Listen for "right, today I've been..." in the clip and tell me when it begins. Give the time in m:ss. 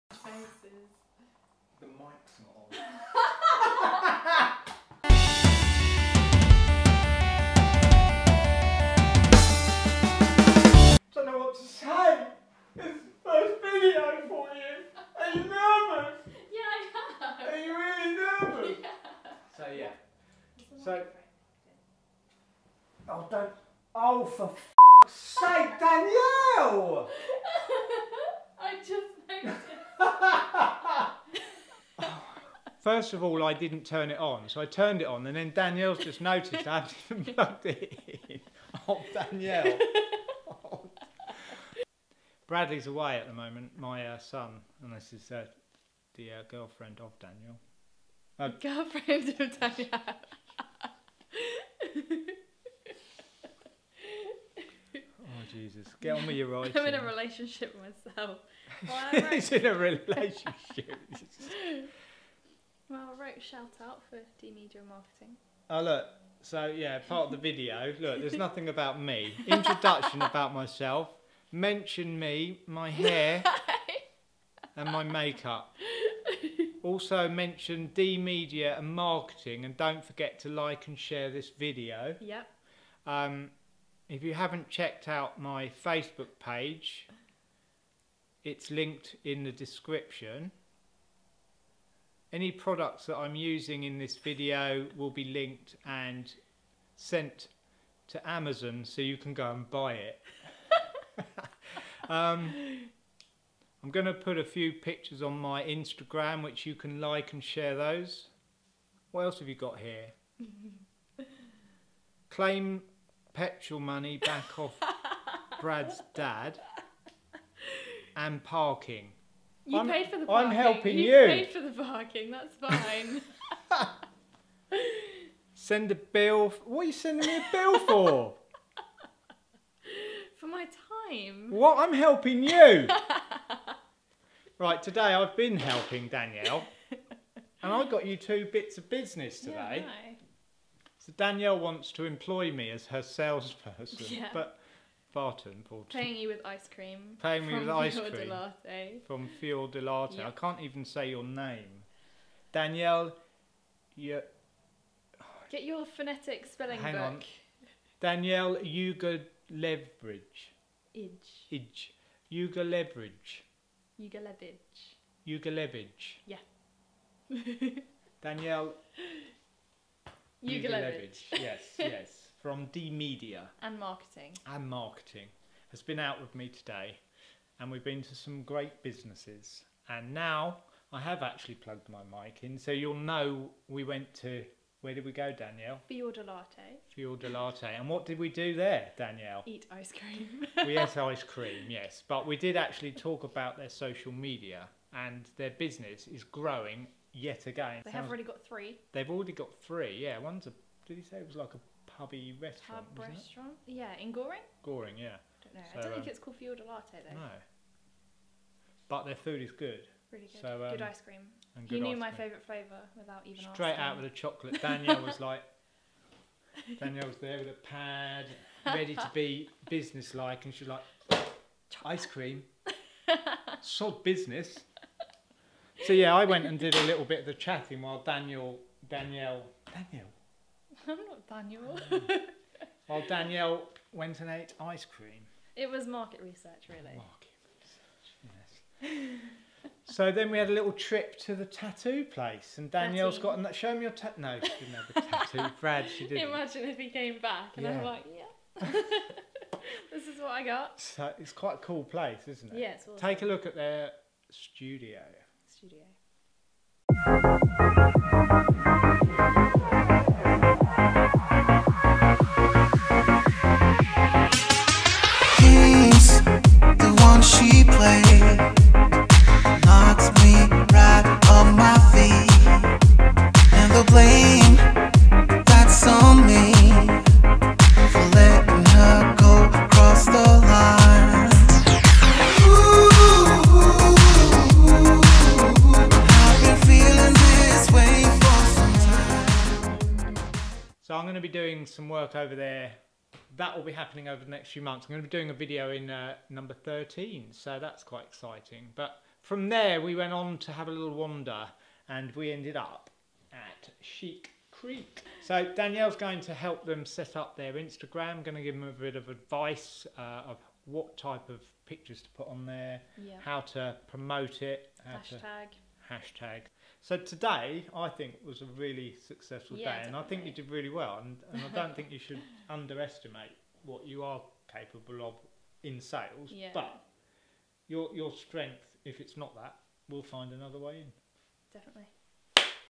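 2:14.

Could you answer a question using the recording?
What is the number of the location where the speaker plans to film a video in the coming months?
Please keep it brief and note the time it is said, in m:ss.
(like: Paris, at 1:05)
13, at 4:56.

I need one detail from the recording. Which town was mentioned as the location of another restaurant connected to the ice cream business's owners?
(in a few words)
Goring.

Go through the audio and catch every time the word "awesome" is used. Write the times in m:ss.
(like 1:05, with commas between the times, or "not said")
4:12.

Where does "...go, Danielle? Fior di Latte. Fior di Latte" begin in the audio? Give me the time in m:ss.
3:05.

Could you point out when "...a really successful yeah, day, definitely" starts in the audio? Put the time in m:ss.
5:18.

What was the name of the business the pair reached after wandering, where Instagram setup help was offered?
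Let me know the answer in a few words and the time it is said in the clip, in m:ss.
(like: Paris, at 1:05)
Sheik Creek, at 5:03.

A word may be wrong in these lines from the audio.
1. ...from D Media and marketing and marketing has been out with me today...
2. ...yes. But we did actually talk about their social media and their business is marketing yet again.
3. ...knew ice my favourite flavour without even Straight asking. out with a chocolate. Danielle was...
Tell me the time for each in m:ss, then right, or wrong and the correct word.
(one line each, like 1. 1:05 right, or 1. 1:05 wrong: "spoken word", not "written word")
1. 2:52 right
2. 3:11 wrong: "growing", not "marketing"
3. 3:31 right.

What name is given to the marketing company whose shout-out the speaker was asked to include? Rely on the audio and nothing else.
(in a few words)
D Media Marketing.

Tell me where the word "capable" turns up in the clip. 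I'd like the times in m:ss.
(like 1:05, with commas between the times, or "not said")
5:24.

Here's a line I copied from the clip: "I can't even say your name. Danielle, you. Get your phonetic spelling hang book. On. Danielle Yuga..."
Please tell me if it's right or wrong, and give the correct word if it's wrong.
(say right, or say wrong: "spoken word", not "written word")
right.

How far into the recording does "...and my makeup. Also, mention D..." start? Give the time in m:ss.
1:14.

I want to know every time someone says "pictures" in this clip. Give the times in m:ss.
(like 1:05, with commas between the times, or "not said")
1:44, 5:11.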